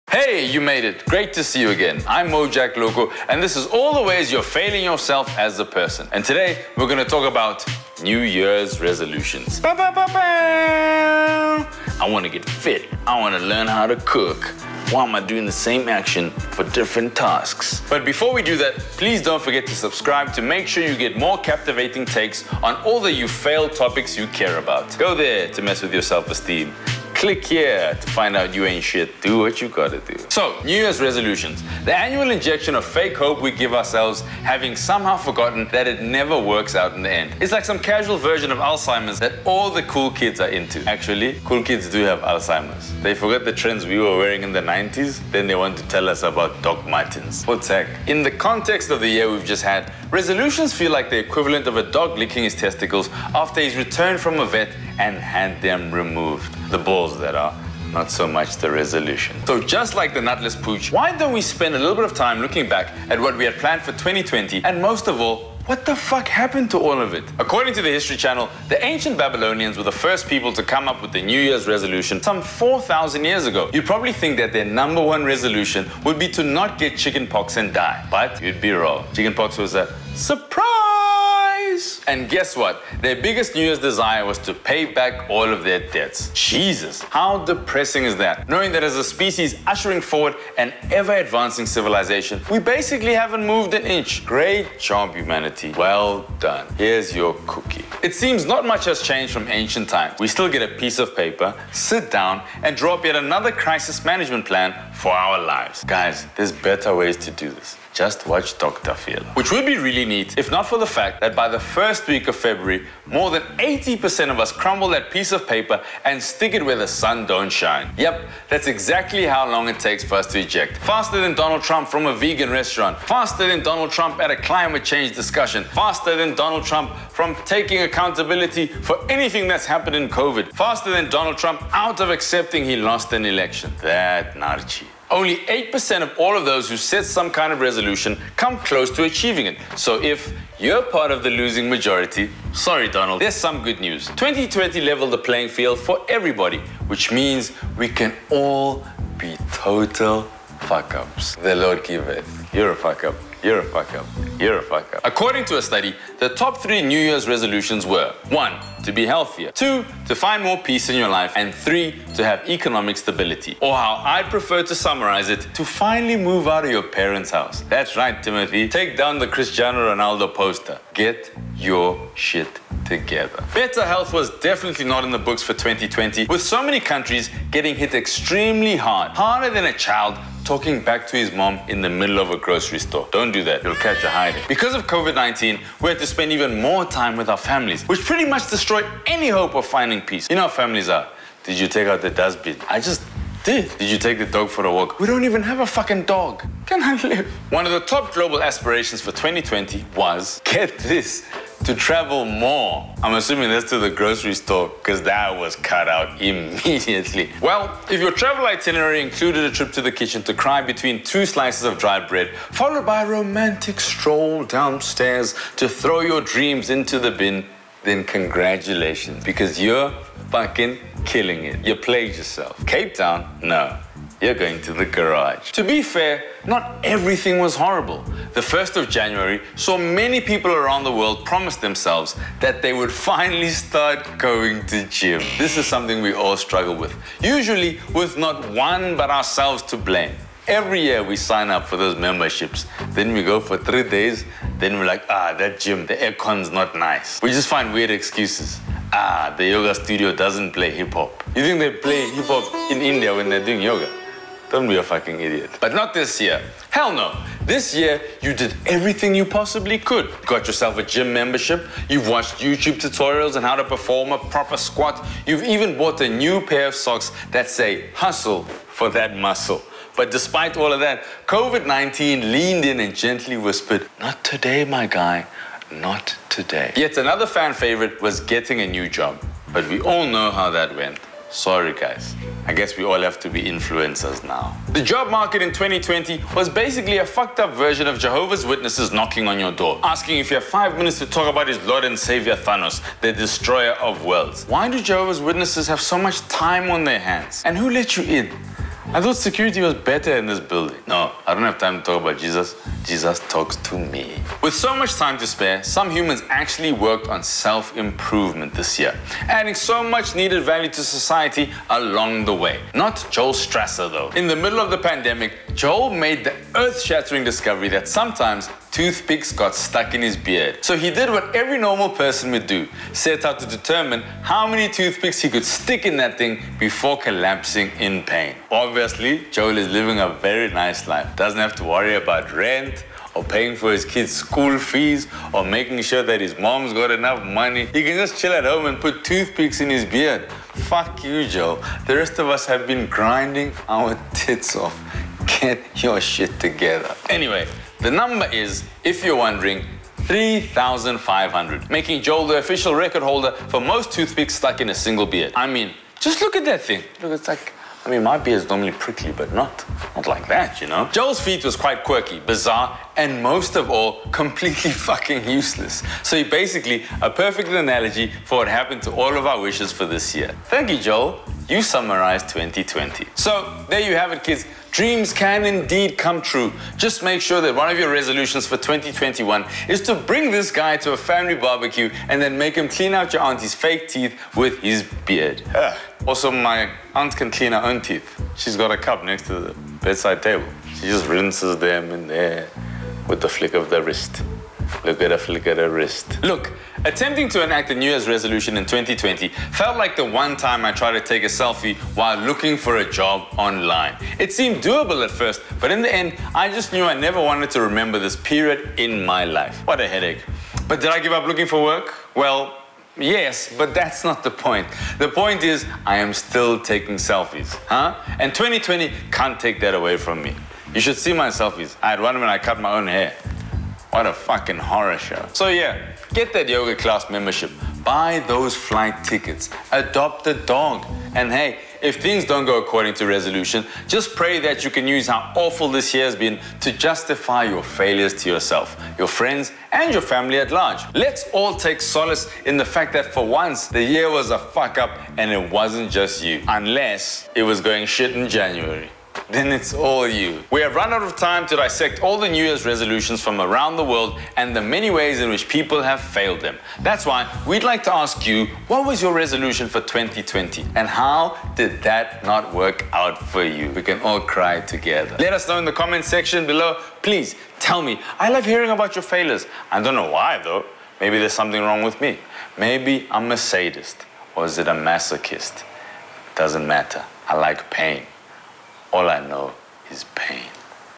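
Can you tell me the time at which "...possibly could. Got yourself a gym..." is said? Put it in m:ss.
4:19.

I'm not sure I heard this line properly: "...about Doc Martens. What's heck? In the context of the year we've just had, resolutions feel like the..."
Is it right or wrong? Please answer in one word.
right.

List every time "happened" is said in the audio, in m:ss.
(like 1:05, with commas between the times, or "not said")
1:06, 2:09, 6:08.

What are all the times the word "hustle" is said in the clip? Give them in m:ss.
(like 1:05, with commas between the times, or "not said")
4:27.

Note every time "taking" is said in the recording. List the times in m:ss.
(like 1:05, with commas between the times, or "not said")
2:07, 6:56.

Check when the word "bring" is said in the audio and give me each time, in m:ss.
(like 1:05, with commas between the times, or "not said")
6:19.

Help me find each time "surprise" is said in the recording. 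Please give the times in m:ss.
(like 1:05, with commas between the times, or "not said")
1:20.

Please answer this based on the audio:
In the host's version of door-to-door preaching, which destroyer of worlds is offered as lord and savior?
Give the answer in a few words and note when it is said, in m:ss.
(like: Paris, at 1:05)
Thanos, at 4:52.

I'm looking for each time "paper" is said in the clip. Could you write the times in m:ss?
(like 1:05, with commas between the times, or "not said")
1:41, 1:55.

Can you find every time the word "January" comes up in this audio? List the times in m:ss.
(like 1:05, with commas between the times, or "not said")
3:48, 7:28.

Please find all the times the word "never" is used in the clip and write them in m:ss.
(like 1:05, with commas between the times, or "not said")
0:36, 6:46.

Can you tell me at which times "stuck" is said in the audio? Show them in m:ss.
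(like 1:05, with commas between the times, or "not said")
5:19, 5:54.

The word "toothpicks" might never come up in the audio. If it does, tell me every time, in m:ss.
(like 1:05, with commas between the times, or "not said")
5:18, 5:24, 5:39, 5:53.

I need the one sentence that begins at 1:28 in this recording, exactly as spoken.
Knowing that as a species ushering forward an ever advancing civilization, we basically haven't moved an inch.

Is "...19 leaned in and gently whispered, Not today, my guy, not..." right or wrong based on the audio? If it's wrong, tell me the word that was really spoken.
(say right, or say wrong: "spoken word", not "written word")
right.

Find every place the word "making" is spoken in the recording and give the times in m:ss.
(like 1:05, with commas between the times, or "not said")
5:35, 5:51.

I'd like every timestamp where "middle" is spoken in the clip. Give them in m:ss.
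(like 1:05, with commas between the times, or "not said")
3:01, 5:14.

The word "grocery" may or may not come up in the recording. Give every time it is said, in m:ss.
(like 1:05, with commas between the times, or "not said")
3:02, 3:23.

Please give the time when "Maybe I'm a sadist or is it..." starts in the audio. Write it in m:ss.
7:52.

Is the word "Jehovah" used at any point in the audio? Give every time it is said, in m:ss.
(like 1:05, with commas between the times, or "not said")
4:47, 4:54.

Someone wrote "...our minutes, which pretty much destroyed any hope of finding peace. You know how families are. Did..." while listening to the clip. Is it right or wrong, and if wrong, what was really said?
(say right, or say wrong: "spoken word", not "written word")
wrong: "families", not "minutes".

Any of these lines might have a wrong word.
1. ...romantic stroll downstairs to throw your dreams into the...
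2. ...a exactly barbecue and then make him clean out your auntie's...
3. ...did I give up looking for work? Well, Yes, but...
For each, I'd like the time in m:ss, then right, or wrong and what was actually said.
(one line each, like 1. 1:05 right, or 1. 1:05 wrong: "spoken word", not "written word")
1. 3:33 right
2. 6:20 wrong: "family", not "exactly"
3. 6:50 right.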